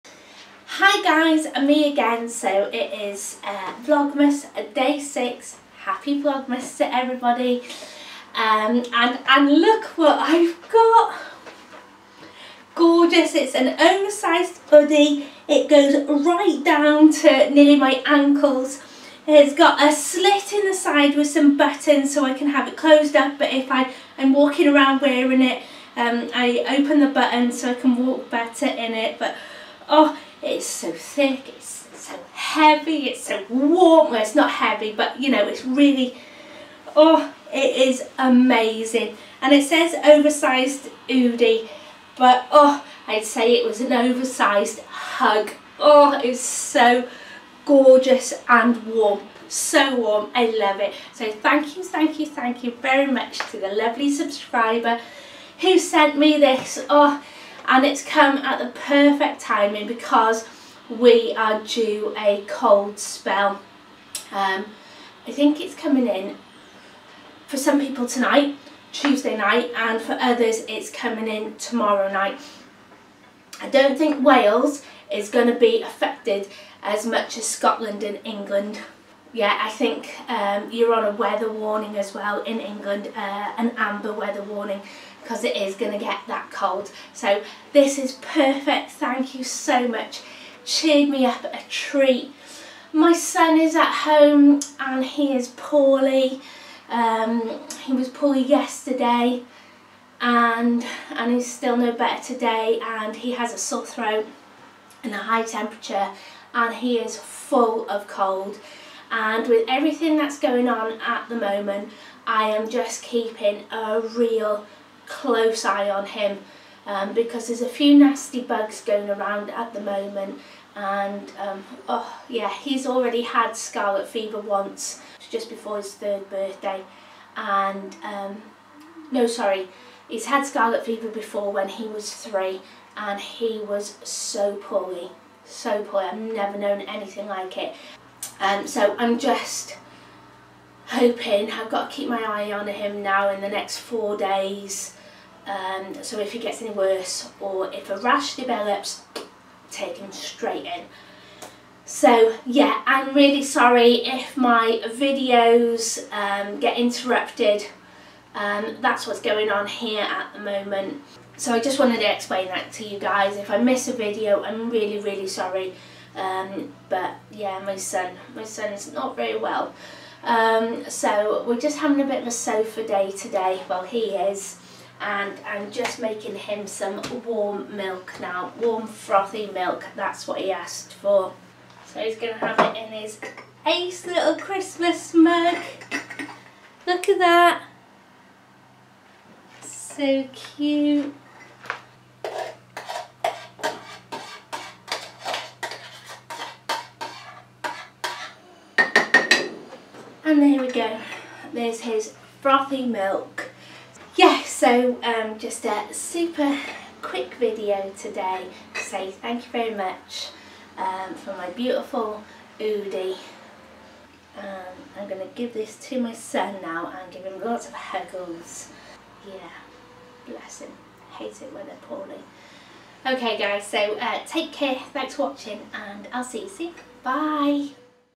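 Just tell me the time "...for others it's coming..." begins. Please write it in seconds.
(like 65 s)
70 s.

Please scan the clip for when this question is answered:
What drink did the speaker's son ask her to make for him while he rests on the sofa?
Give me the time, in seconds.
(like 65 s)
178 s.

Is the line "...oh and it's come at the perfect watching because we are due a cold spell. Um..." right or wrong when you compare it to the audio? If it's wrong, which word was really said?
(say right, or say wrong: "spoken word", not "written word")
wrong: "timing", not "watching".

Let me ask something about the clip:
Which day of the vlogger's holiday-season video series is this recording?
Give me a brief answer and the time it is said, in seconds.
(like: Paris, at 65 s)
Day 6, at 4 s.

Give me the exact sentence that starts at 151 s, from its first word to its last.
So yeah, I'm really sorry if my videos um, get interrupted.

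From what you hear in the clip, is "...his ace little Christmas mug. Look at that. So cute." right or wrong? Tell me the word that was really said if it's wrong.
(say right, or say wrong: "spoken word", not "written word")
right.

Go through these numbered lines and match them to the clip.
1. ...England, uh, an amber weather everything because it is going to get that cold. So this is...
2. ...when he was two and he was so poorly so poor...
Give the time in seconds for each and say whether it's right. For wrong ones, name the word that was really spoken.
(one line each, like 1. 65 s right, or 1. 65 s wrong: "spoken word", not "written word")
1. 82 s wrong: "warning", not "everything"
2. 131 s wrong: "three", not "two".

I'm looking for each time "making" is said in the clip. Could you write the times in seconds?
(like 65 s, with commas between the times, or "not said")
175 s.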